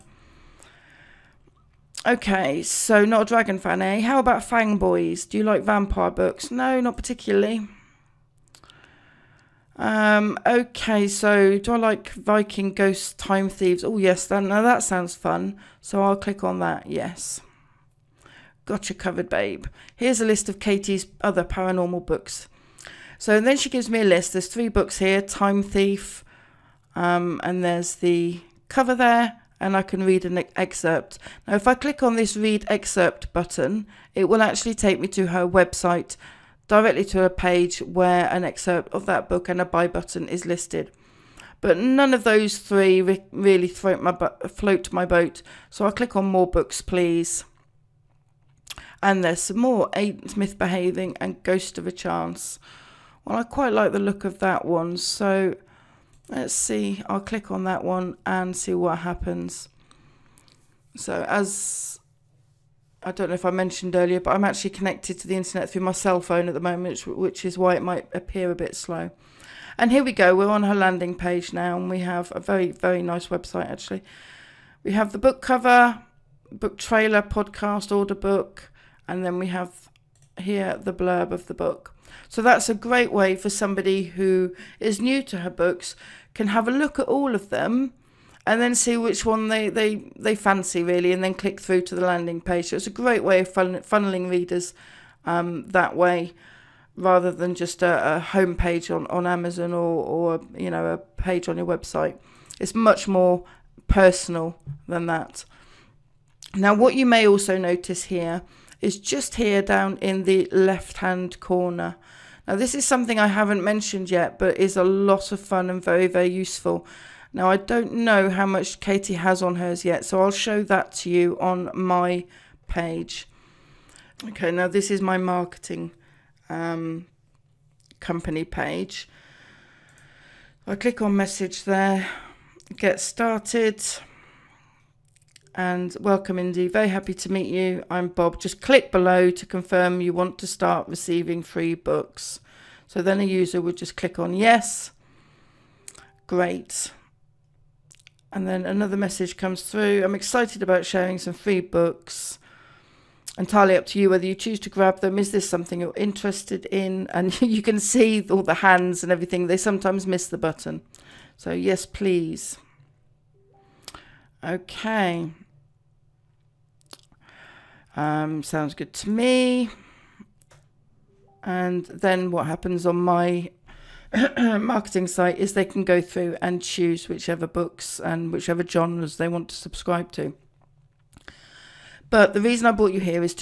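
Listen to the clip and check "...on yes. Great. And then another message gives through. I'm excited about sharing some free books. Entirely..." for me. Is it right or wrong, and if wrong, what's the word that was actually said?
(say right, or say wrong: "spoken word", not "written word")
wrong: "comes", not "gives".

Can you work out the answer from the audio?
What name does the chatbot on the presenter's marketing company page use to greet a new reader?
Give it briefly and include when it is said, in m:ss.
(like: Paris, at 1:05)
Bob, at 2:18.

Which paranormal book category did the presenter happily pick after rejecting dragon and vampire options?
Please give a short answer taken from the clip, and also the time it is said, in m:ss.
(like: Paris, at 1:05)
Viking Ghost Time Thieves, at 0:12.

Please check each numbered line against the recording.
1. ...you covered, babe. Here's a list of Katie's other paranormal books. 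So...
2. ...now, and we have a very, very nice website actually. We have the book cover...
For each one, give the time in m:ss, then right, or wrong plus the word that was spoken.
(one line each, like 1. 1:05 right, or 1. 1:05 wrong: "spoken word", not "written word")
1. 0:18 right
2. 1:11 right.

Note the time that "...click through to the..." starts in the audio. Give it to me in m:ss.
1:31.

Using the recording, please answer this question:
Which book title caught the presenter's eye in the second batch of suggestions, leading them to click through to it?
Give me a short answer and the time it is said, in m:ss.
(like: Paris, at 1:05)
Ghost of a Chance, at 0:51.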